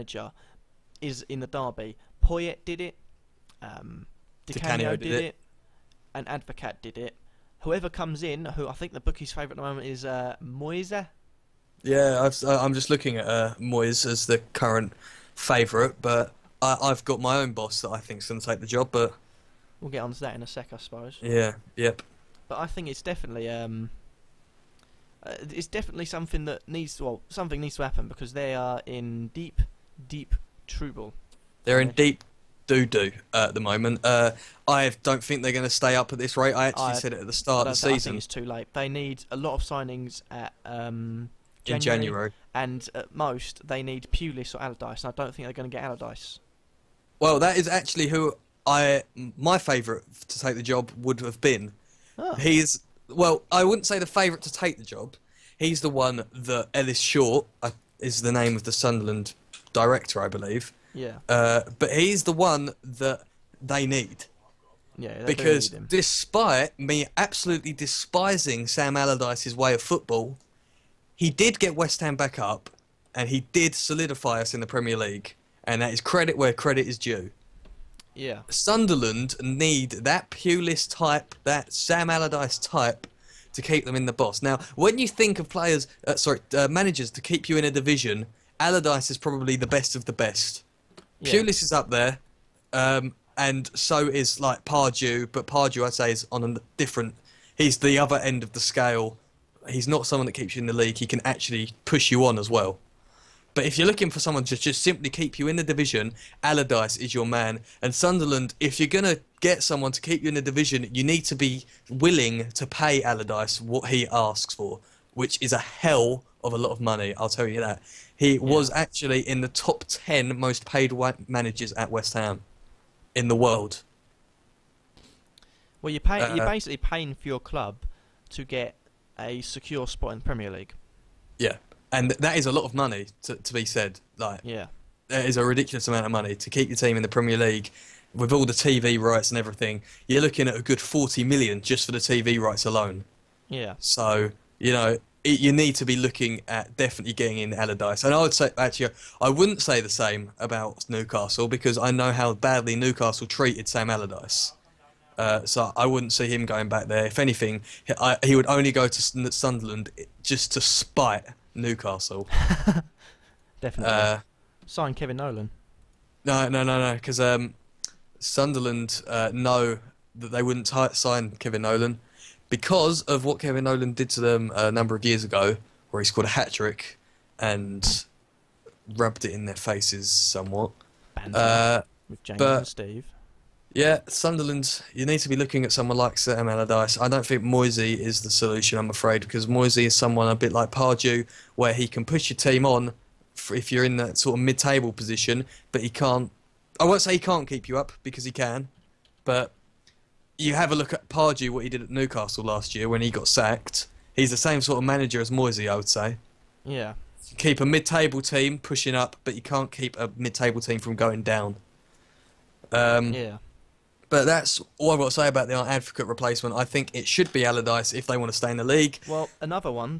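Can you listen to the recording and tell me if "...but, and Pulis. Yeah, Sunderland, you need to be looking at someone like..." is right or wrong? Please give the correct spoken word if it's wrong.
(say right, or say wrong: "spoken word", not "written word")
wrong: "Steve", not "Pulis".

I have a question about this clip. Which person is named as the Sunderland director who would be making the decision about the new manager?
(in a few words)
Ellis Short.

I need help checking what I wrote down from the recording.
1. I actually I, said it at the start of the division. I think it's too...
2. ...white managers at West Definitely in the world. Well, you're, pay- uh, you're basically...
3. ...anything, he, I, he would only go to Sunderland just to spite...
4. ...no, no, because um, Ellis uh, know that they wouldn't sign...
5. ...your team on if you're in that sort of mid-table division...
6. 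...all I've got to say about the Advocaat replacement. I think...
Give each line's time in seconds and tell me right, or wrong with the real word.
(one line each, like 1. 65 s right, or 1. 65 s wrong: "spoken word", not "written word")
1. 36 s wrong: "season", not "division"
2. 120 s wrong: "Ham", not "Definitely"
3. 157 s right
4. 166 s wrong: "Sunderland", not "Ellis"
5. 192 s wrong: "position", not "division"
6. 214 s right.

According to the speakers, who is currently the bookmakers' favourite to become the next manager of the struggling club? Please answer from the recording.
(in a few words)
Moyes.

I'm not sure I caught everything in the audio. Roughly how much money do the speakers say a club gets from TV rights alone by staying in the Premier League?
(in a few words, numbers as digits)
40 million.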